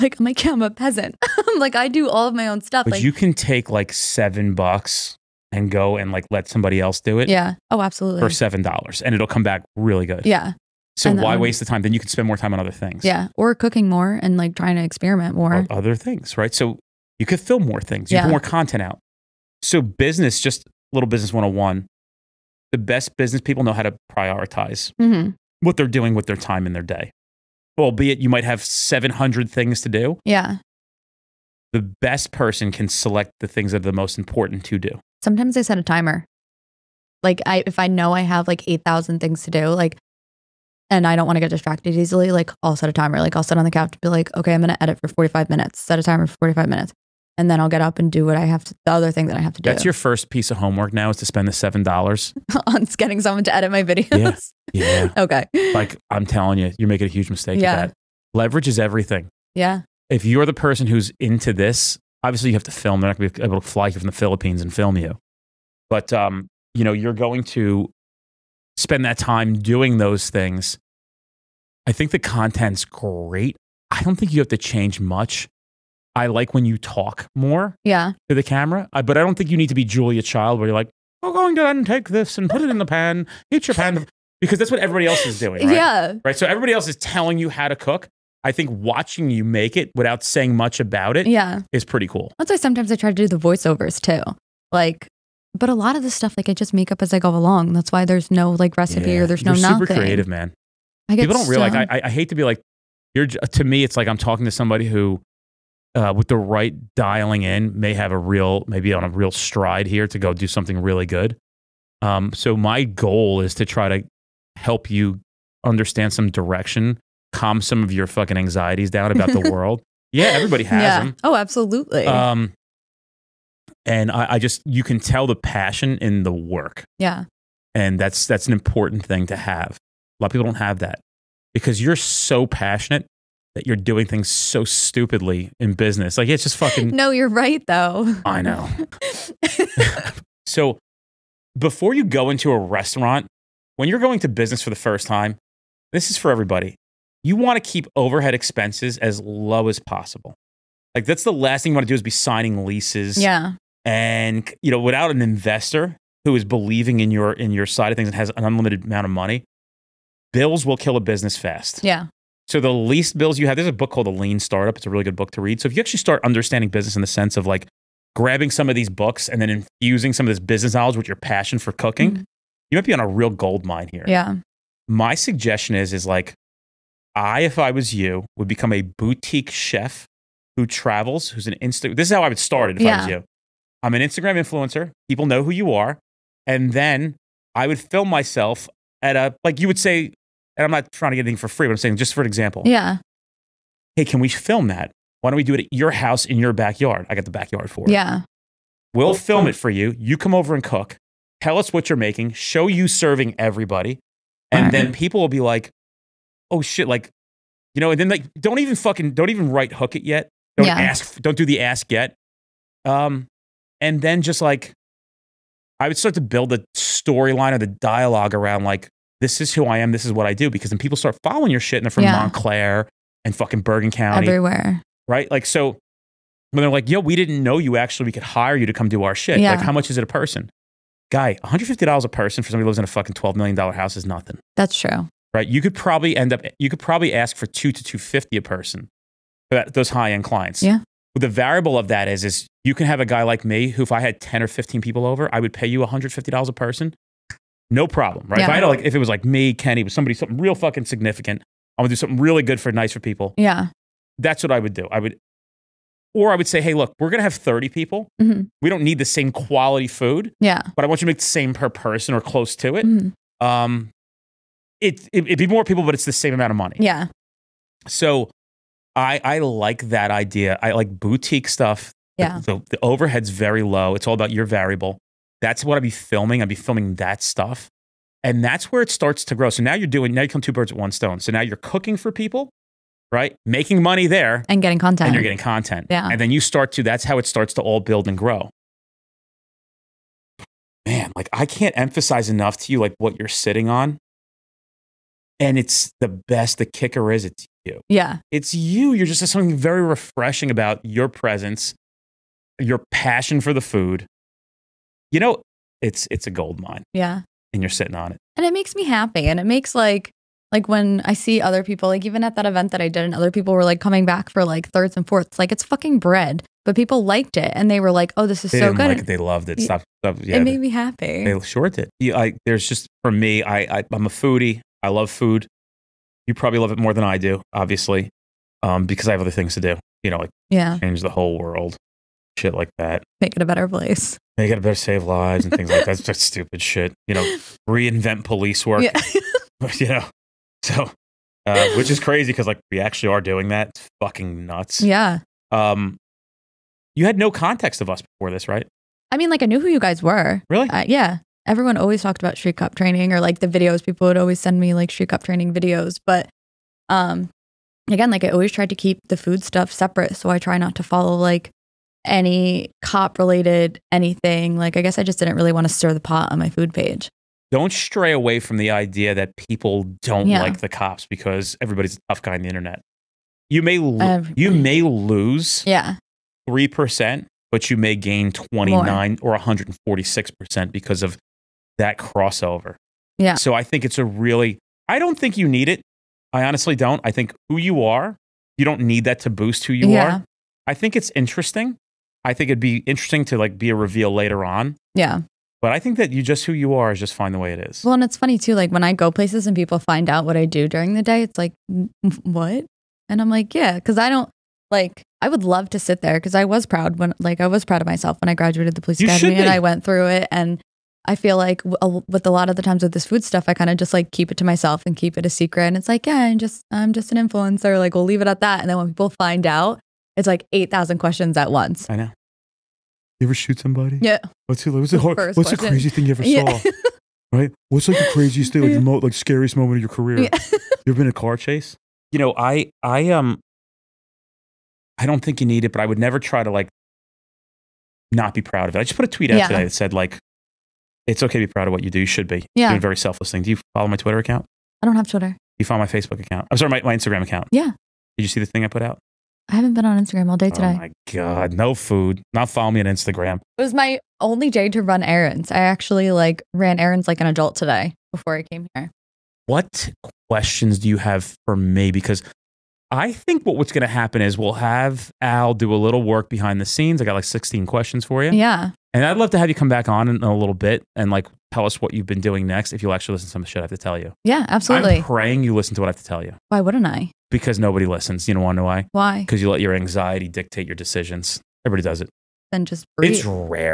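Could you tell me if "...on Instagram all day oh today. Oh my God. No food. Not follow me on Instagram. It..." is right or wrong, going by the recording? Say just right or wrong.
right.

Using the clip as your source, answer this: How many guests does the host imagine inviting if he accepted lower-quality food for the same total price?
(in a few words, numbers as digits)
30.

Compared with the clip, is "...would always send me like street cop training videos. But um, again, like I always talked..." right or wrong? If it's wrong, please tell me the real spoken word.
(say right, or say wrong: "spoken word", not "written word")
wrong: "tried", not "talked".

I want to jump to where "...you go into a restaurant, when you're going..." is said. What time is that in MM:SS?
02:21.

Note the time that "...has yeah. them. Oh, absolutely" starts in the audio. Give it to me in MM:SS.
02:00.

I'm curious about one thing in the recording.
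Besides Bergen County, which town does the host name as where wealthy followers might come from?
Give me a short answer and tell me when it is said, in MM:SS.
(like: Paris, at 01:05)
Montclair, at 03:42.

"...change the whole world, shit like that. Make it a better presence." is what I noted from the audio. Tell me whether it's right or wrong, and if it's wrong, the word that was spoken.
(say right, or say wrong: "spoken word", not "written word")
wrong: "place", not "presence".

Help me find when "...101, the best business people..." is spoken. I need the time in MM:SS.
00:21.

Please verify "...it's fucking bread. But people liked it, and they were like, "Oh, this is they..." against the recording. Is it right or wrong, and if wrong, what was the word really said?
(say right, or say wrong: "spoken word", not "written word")
right.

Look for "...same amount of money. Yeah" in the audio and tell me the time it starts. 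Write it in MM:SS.
04:26.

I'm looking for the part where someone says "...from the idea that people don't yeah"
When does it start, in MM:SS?
06:08.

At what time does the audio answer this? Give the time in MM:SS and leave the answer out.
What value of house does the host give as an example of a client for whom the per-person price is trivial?
03:53.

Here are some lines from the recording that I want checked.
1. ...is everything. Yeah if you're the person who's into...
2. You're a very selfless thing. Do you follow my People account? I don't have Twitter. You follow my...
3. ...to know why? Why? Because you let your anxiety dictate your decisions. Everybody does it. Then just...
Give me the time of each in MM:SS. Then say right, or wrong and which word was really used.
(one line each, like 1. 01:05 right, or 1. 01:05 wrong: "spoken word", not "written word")
1. 00:58 right
2. 07:22 wrong: "Twitter", not "People"
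3. 07:58 right.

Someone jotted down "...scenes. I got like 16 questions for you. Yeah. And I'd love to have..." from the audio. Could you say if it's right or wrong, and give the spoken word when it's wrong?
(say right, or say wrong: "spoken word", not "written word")
right.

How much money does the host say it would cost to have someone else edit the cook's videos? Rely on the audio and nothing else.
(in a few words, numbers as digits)
$7.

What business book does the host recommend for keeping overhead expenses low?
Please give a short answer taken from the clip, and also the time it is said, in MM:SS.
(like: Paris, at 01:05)
The Lean Startup, at 02:44.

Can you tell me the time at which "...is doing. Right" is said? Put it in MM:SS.
01:25.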